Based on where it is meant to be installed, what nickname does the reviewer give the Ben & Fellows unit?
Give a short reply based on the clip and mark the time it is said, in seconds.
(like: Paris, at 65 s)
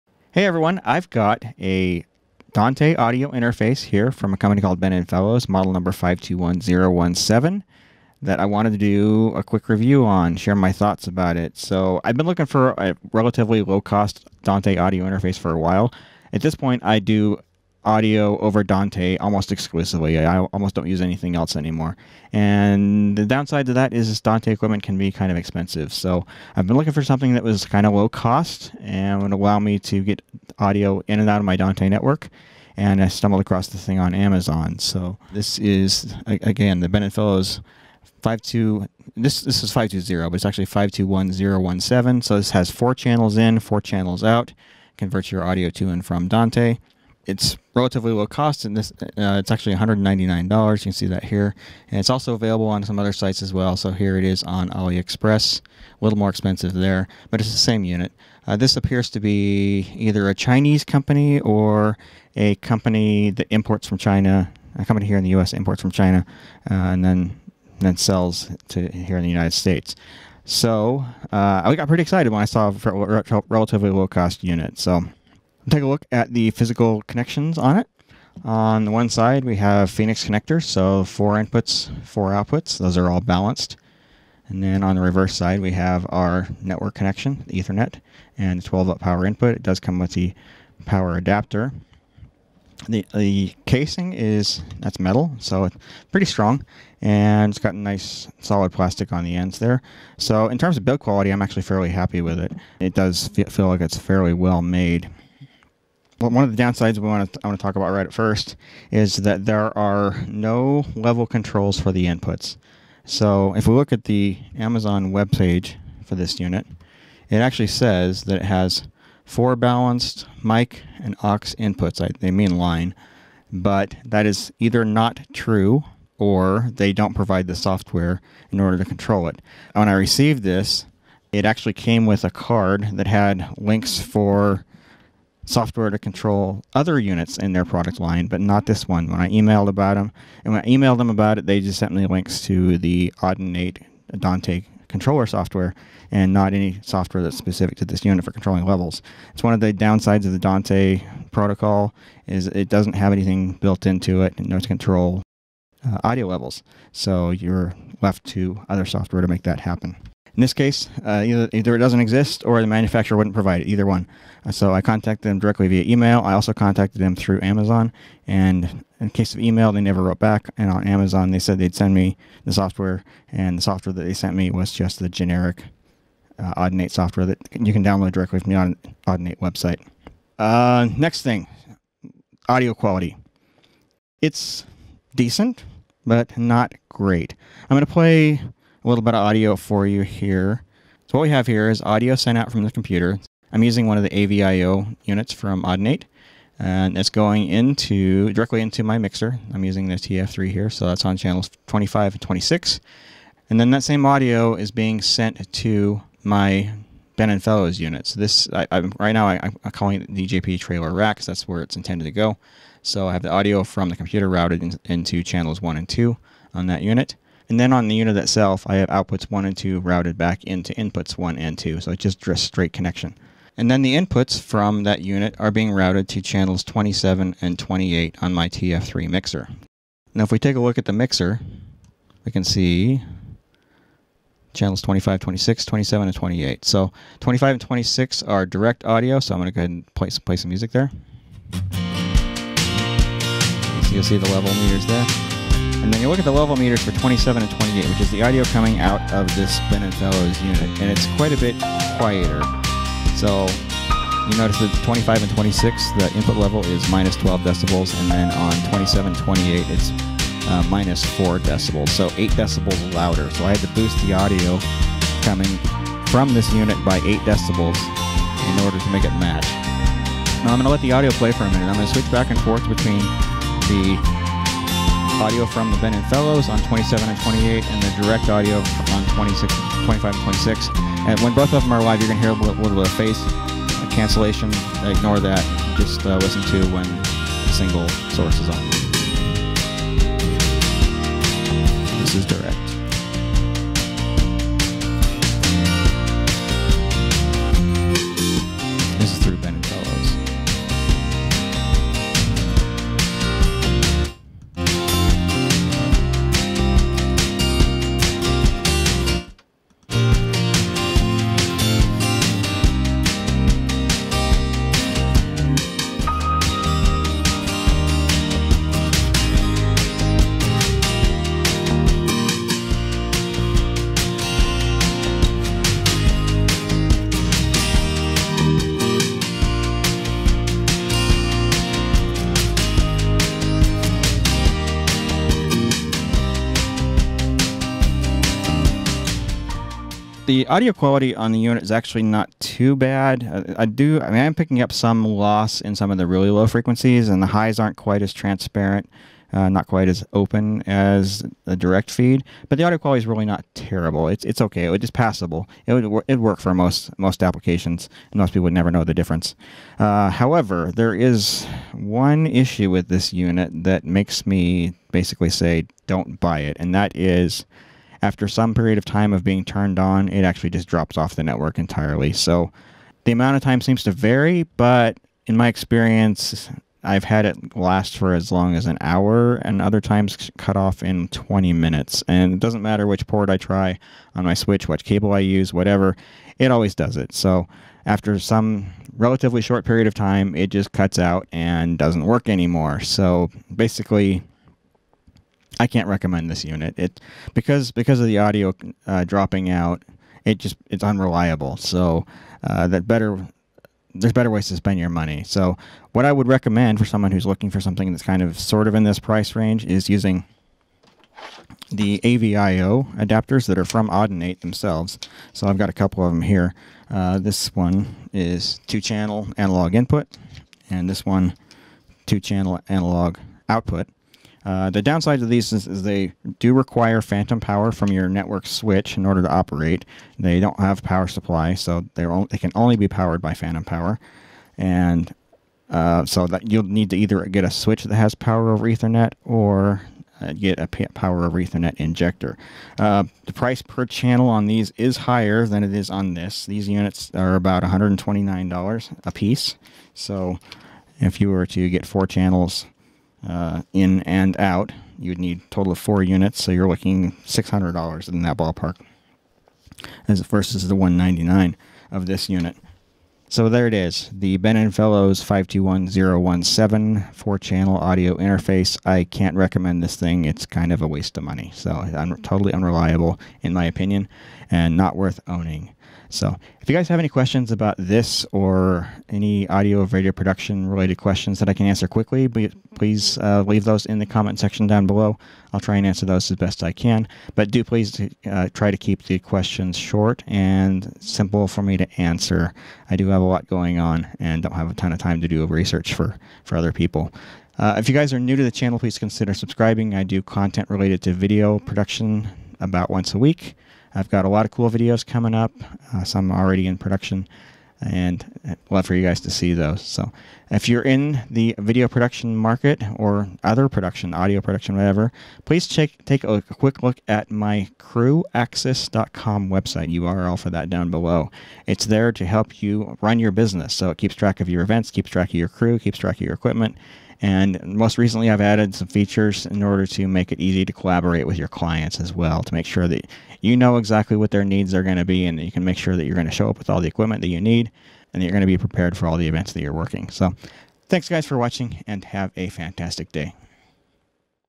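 JP trailer rack, at 210 s.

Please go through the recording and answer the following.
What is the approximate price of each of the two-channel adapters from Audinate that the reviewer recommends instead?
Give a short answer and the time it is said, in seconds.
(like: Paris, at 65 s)
$129, at 447 s.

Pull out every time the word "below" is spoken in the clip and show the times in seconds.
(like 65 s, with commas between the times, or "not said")
484 s, 520 s.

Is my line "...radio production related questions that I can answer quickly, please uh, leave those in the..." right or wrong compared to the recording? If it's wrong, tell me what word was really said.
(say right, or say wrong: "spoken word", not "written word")
right.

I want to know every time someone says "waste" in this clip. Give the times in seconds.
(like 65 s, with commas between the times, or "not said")
470 s.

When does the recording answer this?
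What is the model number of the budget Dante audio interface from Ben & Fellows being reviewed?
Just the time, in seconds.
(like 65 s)
5 s.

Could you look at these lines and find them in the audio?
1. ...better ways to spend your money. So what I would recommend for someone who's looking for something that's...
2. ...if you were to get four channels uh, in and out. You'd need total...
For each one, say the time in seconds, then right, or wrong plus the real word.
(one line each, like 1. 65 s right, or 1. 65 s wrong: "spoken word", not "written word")
1. 404 s right
2. 450 s right.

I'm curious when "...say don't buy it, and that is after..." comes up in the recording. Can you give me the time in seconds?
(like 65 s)
365 s.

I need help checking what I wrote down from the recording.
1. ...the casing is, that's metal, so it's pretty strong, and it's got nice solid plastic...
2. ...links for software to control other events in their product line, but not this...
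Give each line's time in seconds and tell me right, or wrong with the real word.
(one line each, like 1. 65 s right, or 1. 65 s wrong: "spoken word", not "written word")
1. 93 s right
2. 133 s wrong: "units", not "events".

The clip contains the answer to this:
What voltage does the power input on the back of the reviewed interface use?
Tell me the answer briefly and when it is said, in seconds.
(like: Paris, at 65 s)
12 volts, at 88 s.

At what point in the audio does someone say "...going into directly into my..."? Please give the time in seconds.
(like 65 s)
197 s.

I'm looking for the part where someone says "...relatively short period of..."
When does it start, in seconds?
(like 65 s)
388 s.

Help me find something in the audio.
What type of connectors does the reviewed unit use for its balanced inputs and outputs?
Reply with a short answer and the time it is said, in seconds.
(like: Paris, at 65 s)
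Phoenix connectors, at 79 s.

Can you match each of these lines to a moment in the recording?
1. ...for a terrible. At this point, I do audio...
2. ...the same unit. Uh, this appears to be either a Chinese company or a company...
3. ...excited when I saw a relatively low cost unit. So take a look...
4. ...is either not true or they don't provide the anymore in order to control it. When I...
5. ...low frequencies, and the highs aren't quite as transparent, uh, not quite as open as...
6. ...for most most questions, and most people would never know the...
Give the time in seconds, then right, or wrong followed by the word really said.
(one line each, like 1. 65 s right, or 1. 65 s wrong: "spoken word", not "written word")
1. 15 s wrong: "while", not "terrible"
2. 57 s right
3. 72 s right
4. 124 s wrong: "software", not "anymore"
5. 346 s right
6. 356 s wrong: "applications", not "questions".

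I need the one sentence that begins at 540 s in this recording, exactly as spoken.
So, thanks guys for watching and have a fantastic day.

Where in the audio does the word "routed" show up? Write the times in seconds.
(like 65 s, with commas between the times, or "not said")
214 s, 219 s, 225 s.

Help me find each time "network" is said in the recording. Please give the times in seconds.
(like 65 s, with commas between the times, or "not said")
31 s, 86 s, 371 s, 428 s.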